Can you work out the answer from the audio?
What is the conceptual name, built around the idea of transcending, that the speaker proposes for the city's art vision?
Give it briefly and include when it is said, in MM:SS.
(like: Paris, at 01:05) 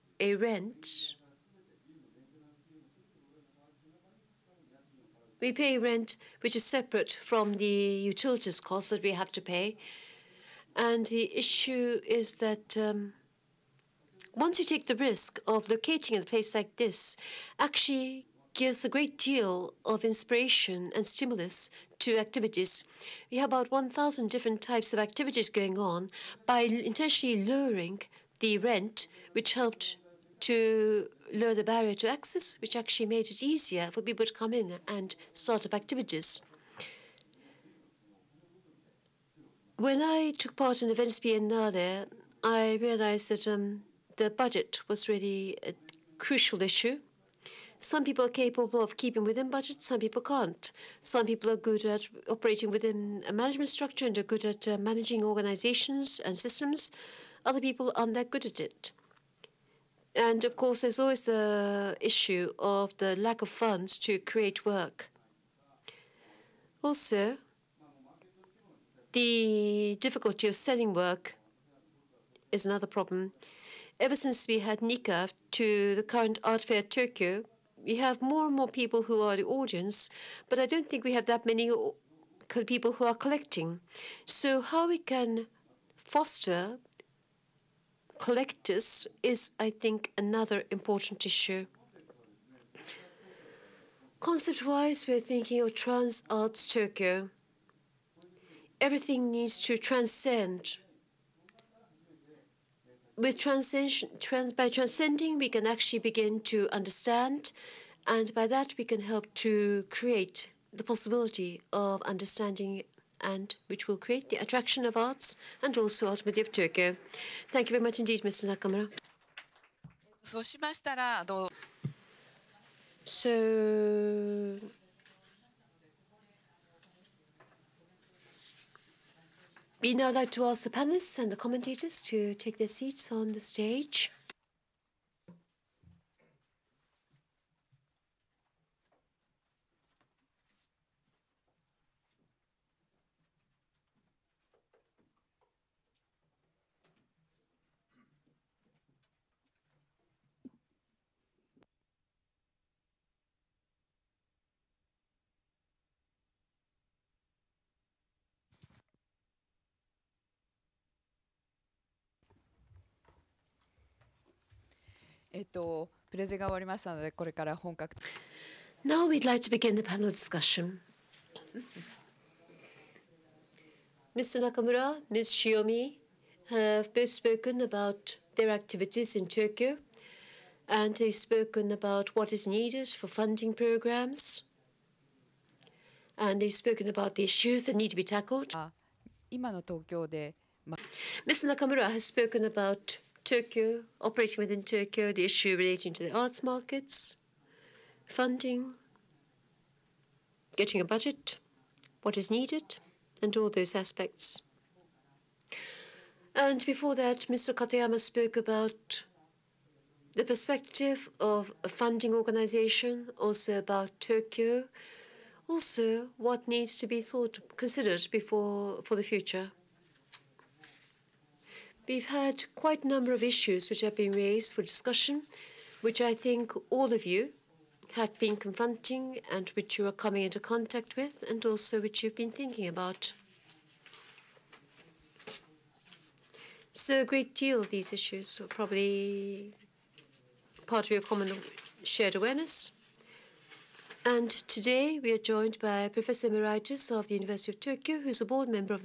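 Trans Arts Tokyo, at 01:35.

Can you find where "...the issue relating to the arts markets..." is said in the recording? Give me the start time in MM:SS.
03:15.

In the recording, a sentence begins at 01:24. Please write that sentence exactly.
So how we can foster collectors is, I think, another important issue.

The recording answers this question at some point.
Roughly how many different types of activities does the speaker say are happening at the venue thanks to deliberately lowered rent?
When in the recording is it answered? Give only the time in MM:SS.
00:23.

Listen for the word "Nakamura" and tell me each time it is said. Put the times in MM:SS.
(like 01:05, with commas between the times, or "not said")
01:58, 02:54, 03:11.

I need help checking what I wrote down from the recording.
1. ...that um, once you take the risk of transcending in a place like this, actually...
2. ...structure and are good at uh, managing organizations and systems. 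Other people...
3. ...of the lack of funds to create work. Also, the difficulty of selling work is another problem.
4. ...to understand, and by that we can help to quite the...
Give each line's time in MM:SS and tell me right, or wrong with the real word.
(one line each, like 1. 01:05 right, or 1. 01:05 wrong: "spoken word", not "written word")
1. 00:12 wrong: "locating", not "transcending"
2. 00:53 right
3. 01:02 right
4. 01:46 wrong: "create", not "quite".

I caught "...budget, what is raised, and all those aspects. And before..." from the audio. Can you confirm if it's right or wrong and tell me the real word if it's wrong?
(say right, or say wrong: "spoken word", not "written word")
wrong: "needed", not "raised".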